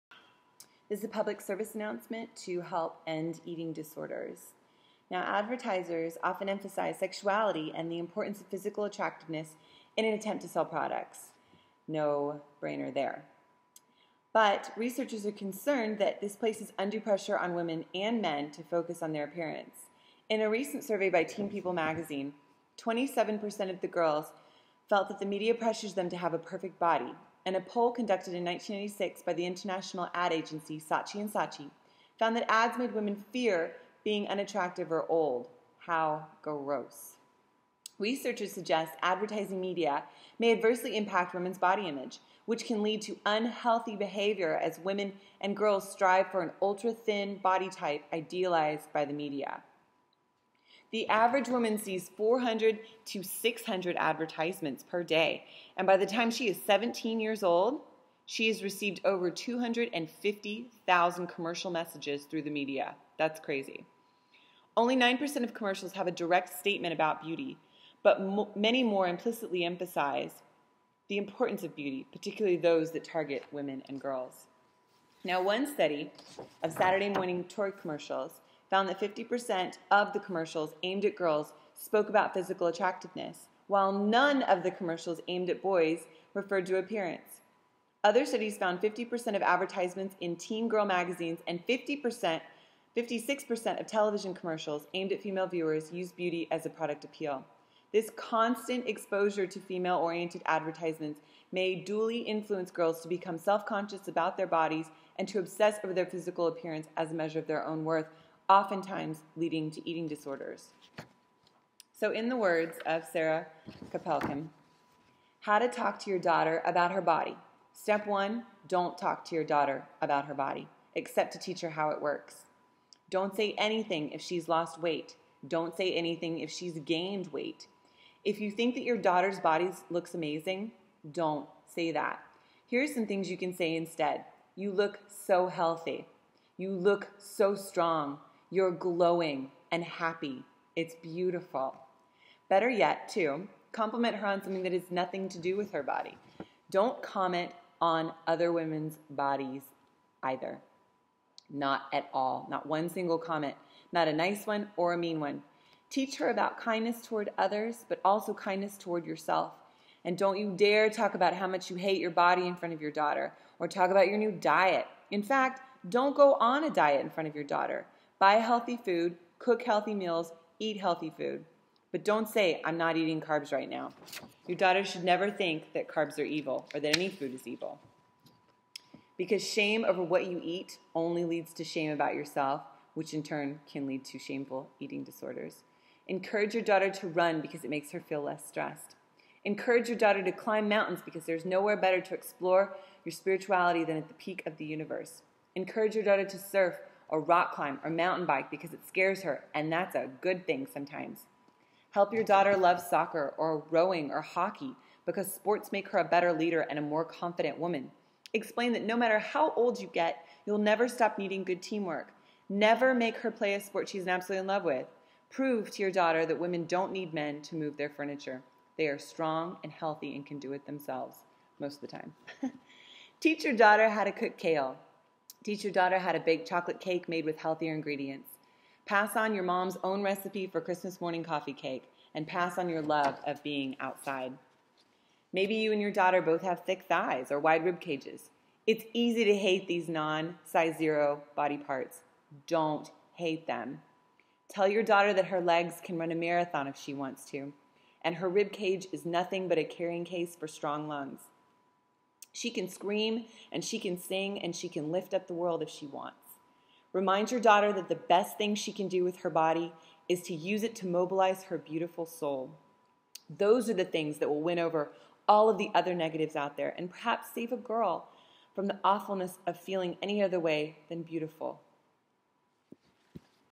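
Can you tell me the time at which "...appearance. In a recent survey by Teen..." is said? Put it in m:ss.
0:19.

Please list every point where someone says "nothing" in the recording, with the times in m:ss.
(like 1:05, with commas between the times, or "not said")
2:24, 4:09.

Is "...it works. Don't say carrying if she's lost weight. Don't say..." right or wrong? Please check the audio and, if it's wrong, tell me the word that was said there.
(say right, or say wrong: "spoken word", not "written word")
wrong: "anything", not "carrying".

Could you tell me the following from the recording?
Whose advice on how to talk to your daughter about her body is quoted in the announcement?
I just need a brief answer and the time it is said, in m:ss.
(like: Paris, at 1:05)
Sarah Koppelkam, at 1:53.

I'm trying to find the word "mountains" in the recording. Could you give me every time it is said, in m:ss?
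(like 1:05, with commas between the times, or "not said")
3:10, 3:17.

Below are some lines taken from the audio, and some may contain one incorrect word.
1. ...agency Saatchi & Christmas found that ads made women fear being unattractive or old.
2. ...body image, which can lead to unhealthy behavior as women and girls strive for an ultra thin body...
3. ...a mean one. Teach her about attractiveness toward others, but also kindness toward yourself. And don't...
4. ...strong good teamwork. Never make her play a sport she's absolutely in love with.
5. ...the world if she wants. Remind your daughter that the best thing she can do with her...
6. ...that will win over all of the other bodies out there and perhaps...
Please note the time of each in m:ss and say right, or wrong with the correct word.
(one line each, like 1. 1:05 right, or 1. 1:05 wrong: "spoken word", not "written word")
1. 0:30 wrong: "Saatchi", not "Christmas"
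2. 0:41 right
3. 2:34 wrong: "kindness", not "attractiveness"
4. 3:31 wrong: "needing", not "strong"
5. 4:15 right
6. 4:24 wrong: "negatives", not "bodies".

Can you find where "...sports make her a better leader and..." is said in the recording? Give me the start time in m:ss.
3:25.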